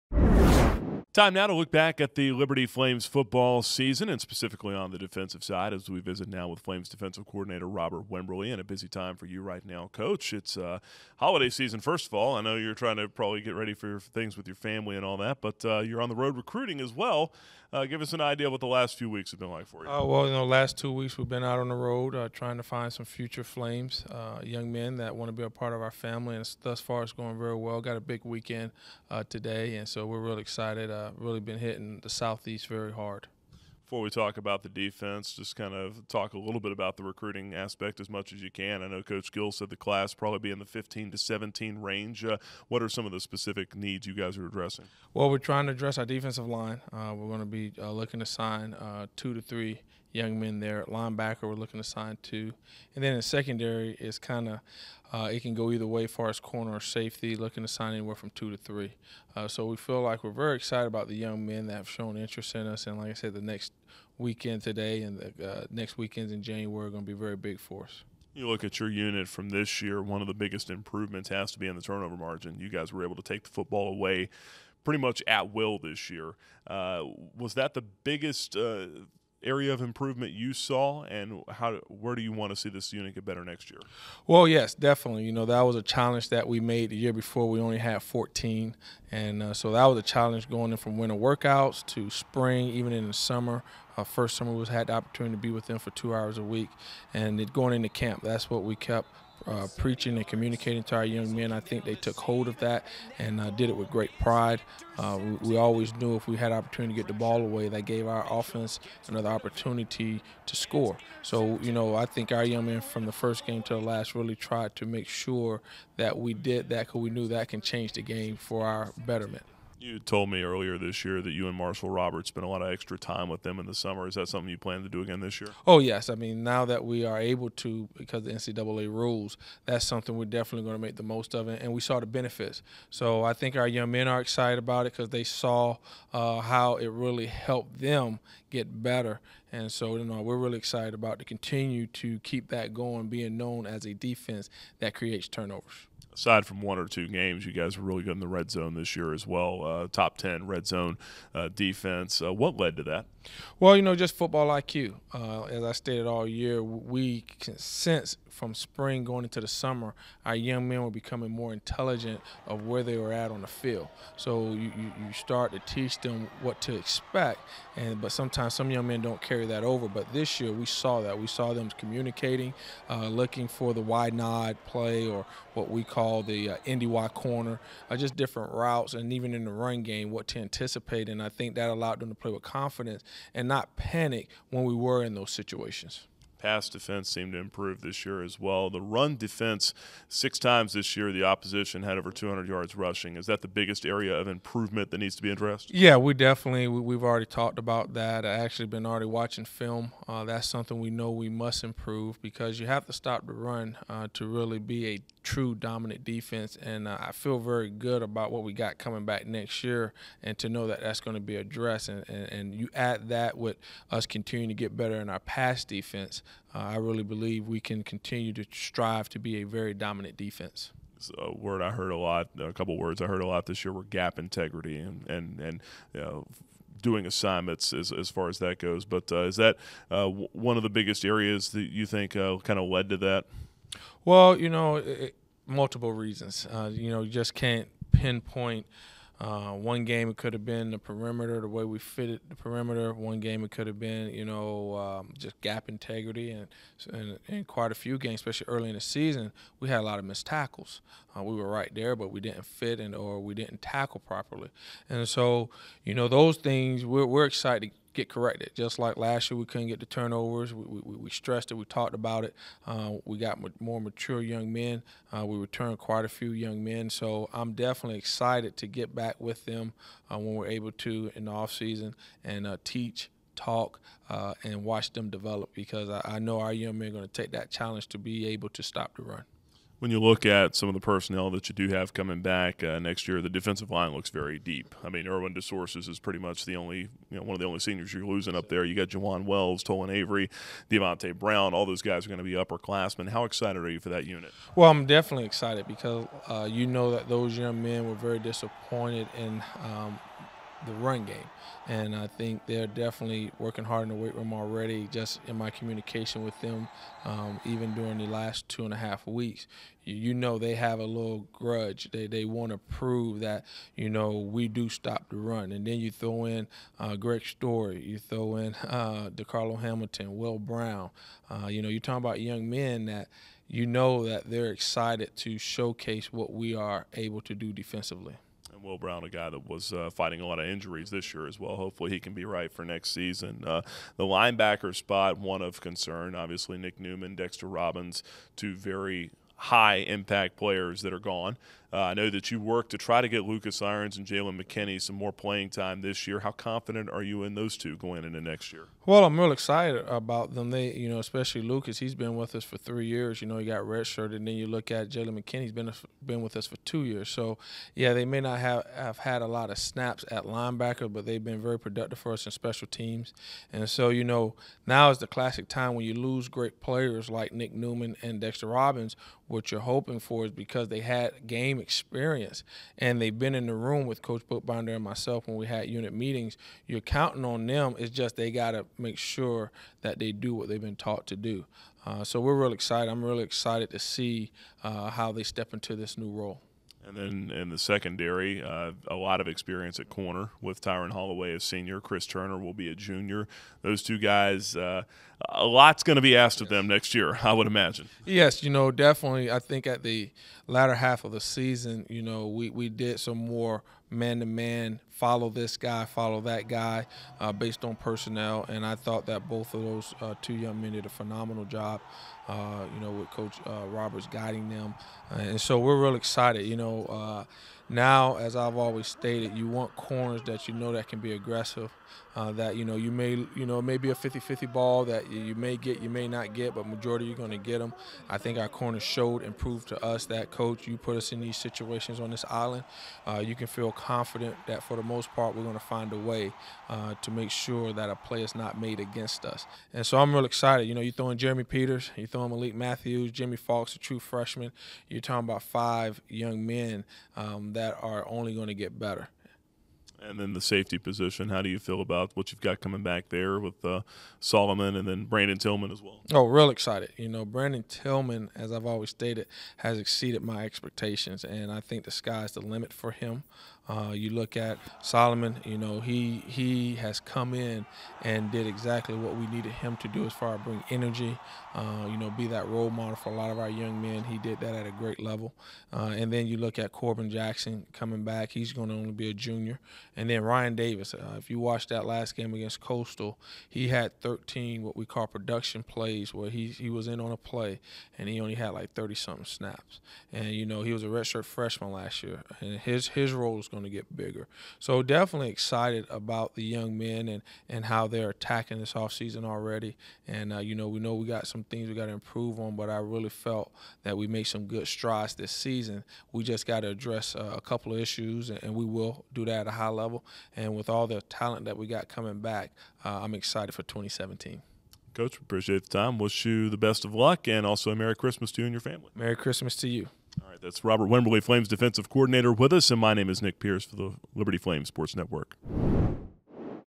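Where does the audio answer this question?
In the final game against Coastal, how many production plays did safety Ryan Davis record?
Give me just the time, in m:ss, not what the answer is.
8:04.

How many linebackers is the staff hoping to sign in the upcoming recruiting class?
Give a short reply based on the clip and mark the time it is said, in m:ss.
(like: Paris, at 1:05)
2, at 0:50.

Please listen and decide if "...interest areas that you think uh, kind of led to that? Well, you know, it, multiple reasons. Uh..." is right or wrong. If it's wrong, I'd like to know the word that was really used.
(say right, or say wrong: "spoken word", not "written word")
wrong: "biggest", not "interest".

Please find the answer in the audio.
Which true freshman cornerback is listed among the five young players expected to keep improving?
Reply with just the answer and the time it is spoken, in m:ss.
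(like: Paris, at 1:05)
Jimmy Fox, at 7:23.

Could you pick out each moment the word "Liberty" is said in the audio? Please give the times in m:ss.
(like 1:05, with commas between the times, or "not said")
0:02, 8:44.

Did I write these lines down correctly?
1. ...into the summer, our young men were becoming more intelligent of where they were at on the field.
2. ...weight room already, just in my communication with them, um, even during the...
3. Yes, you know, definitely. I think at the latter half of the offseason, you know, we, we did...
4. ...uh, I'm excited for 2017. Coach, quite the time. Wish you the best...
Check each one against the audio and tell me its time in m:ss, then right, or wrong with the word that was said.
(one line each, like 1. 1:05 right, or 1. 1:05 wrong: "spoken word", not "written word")
1. 2:39 right
2. 5:03 right
3. 6:38 wrong: "season", not "offseason"
4. 8:32 wrong: "appreciate", not "quite".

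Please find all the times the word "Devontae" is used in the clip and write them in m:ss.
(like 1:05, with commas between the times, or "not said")
4:50.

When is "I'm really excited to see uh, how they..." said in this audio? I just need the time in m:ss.
6:22.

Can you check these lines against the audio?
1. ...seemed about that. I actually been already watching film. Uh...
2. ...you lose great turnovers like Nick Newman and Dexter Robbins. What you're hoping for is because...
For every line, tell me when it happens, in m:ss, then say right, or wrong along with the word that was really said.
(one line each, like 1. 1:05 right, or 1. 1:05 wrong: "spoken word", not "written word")
1. 3:17 wrong: "talked", not "seemed"
2. 6:05 wrong: "players", not "turnovers".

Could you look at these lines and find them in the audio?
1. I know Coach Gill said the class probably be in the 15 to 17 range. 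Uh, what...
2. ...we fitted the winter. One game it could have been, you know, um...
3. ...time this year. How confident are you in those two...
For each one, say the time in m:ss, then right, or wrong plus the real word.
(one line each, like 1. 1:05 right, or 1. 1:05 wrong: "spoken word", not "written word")
1. 0:38 right
2. 4:01 wrong: "perimeter", not "winter"
3. 5:45 right.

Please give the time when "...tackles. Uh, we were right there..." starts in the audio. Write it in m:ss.
4:10.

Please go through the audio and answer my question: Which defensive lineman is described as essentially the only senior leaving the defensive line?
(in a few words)
Irwin DeSources.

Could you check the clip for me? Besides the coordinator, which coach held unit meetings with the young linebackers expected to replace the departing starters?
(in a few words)
Coach Bookbinder.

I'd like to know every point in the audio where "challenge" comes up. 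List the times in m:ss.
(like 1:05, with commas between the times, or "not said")
1:25, 1:30, 4:37.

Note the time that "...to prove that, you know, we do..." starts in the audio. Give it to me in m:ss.
5:12.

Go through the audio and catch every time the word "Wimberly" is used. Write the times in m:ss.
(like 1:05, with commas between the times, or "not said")
0:08, 8:40.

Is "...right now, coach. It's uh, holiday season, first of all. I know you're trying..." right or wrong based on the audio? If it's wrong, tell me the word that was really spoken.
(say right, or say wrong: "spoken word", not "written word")
right.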